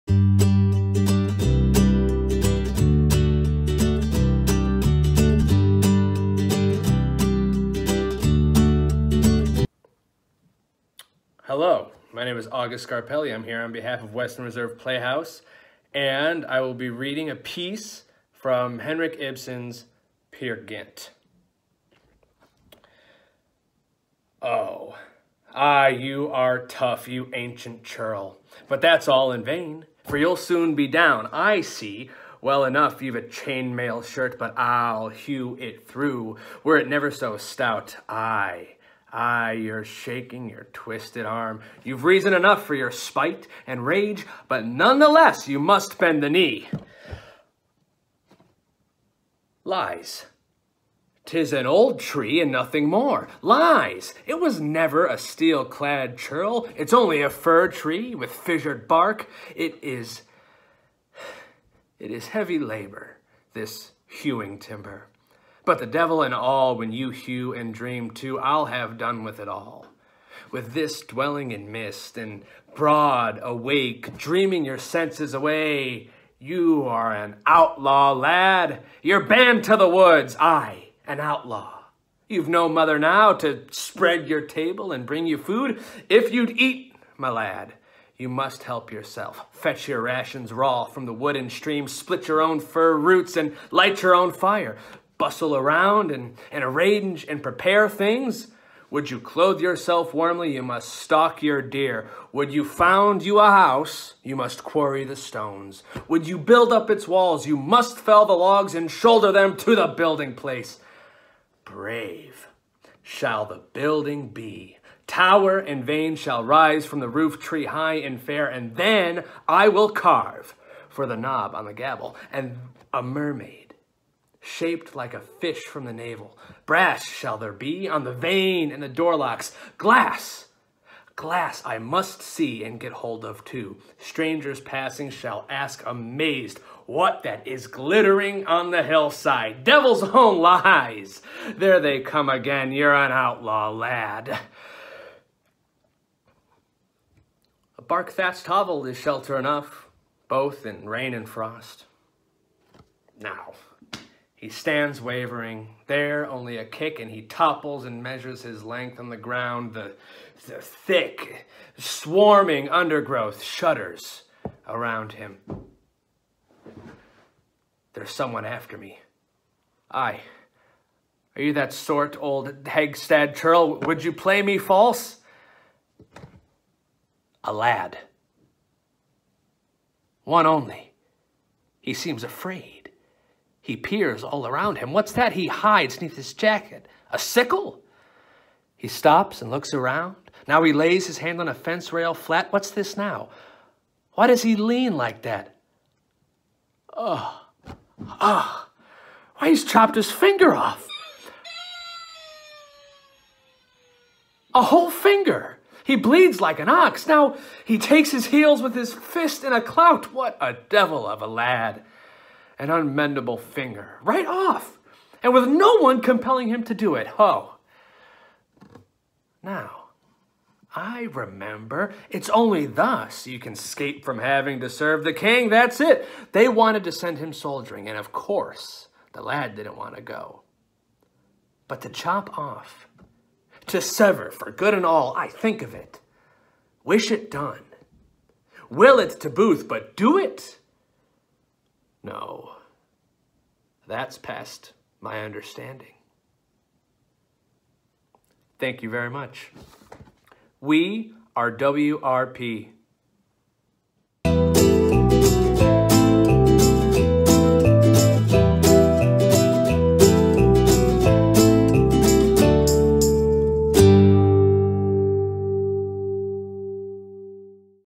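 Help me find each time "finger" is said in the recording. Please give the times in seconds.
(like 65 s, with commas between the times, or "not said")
200 s, 204 s, 213 s.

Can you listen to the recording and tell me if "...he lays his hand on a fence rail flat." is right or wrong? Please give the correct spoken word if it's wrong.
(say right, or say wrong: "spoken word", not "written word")
right.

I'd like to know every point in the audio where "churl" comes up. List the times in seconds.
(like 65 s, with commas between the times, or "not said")
27 s, 56 s, 173 s.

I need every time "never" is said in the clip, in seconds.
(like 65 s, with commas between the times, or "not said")
36 s, 54 s.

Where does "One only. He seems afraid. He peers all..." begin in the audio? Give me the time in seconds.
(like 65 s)
180 s.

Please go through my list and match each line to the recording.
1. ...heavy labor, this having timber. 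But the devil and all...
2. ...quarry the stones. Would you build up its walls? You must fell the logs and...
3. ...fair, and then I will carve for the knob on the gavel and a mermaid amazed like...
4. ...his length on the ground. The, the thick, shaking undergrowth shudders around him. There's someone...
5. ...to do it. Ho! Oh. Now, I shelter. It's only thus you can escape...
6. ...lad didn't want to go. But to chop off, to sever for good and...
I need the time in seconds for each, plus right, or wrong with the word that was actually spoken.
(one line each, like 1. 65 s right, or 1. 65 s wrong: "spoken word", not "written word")
1. 62 s wrong: "hewing", not "having"
2. 104 s right
3. 118 s wrong: "shaped", not "amazed"
4. 158 s wrong: "swarming", not "shaking"
5. 216 s wrong: "remember", not "shelter"
6. 229 s right.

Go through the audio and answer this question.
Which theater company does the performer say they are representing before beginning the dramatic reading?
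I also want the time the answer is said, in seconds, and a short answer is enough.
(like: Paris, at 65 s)
Western Reserve Playhouse, at 14 s.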